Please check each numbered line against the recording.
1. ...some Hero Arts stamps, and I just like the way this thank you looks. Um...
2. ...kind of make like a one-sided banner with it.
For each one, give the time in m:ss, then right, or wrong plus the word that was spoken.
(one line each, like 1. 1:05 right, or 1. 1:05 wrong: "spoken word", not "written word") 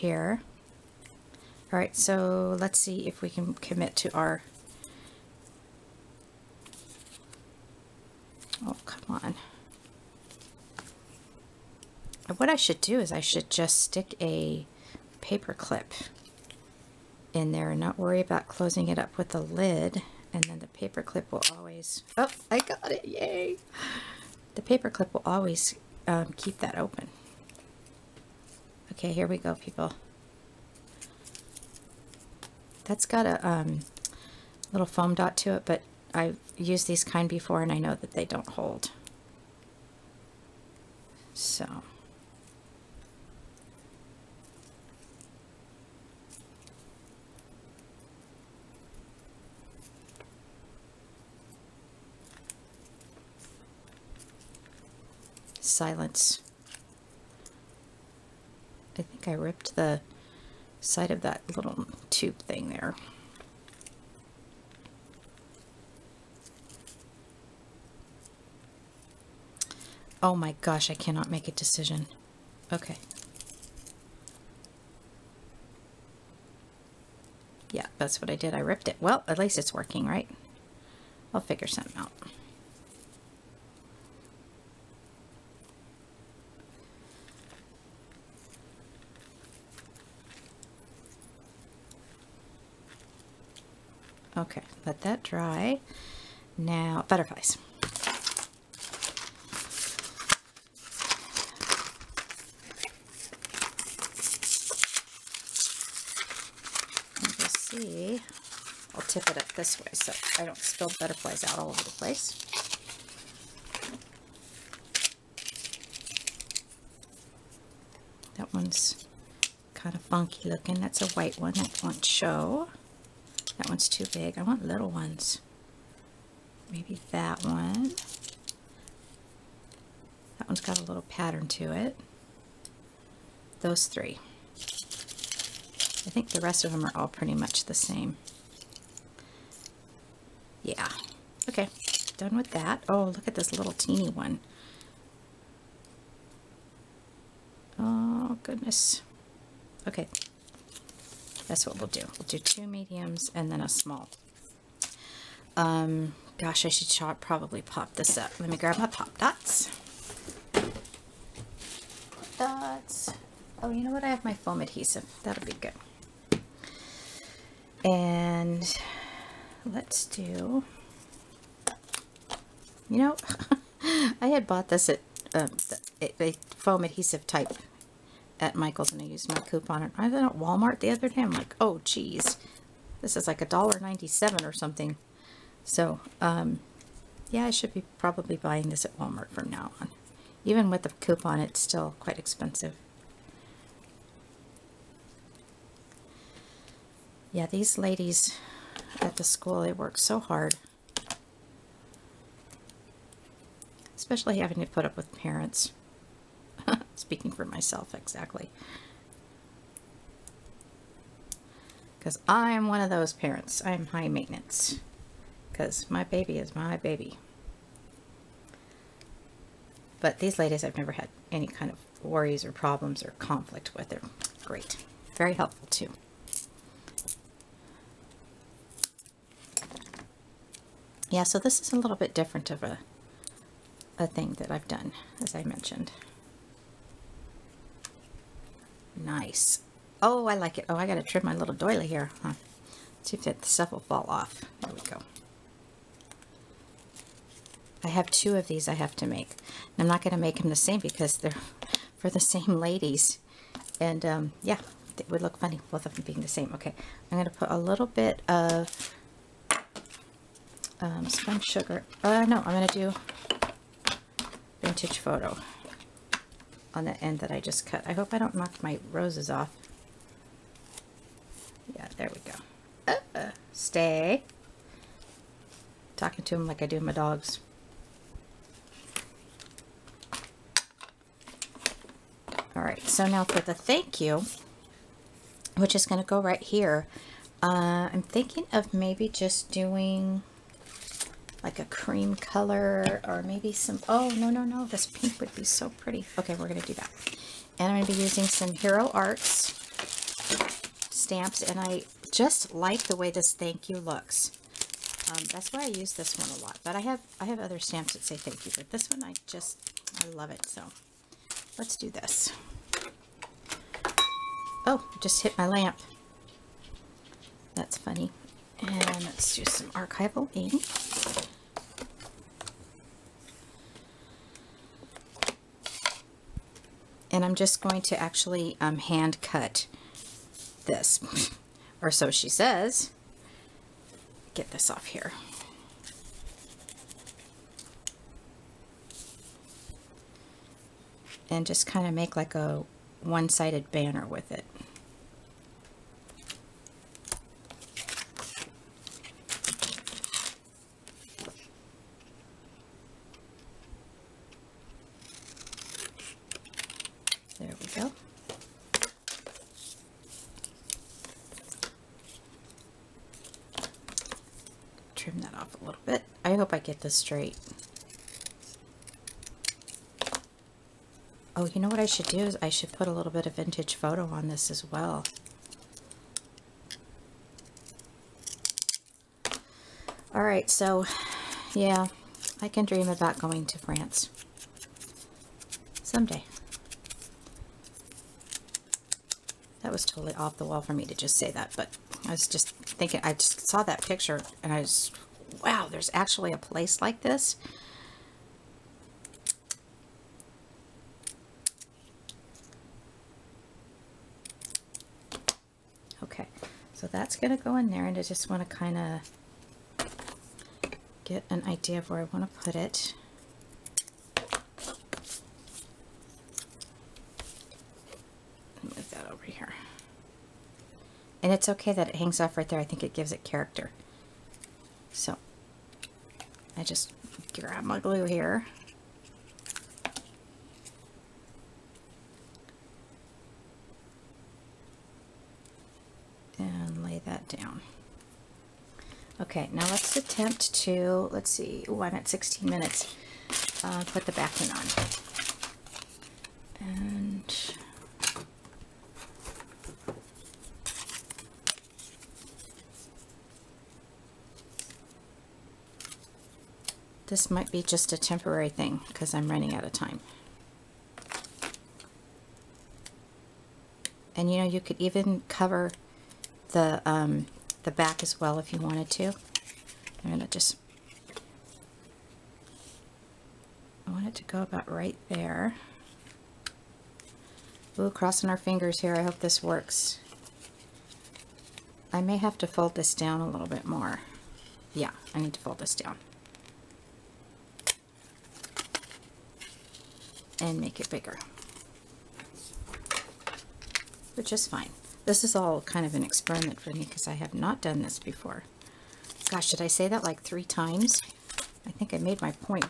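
1. 4:58 right
2. 5:41 right.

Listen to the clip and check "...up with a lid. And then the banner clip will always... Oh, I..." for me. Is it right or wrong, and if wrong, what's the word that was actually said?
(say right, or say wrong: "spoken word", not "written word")
wrong: "paper", not "banner".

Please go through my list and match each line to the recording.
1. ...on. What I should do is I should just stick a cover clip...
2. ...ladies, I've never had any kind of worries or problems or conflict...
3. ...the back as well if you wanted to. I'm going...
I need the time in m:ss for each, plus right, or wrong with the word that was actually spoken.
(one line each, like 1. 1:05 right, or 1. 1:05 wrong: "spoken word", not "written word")
1. 0:09 wrong: "paper", not "cover"
2. 3:40 right
3. 7:47 right.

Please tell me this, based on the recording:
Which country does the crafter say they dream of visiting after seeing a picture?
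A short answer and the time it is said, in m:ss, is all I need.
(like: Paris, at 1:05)
France, at 6:23.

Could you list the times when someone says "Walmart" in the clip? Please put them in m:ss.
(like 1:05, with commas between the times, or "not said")
3:00, 3:08.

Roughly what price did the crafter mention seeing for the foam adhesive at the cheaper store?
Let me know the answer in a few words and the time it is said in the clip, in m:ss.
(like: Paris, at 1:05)
$1.97, at 3:03.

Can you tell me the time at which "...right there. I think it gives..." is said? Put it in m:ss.
7:02.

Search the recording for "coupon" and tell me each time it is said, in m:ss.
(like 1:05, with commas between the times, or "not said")
2:59, 3:11.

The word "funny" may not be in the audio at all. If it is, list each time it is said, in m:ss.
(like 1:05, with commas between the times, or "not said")
4:15, 5:17.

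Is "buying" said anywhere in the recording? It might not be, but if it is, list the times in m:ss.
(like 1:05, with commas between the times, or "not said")
3:08.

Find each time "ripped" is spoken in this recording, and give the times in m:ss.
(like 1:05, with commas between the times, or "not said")
0:59, 1:18.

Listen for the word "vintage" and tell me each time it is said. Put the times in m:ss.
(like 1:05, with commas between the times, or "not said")
4:24, 6:13.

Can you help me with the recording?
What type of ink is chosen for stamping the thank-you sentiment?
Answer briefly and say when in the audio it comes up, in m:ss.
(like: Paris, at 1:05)
archival ink, at 5:19.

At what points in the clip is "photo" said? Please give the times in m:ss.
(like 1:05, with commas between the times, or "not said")
4:24, 6:13.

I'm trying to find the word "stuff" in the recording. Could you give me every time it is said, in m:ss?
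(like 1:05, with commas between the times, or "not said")
4:03.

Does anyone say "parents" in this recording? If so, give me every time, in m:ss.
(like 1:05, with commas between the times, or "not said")
3:25, 3:33.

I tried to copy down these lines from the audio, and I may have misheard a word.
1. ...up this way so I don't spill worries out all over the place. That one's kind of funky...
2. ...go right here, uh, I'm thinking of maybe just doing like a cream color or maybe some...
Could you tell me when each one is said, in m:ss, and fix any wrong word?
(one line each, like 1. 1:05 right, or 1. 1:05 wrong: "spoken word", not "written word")
1. 1:49 wrong: "butterflies", not "worries"
2. 4:46 right.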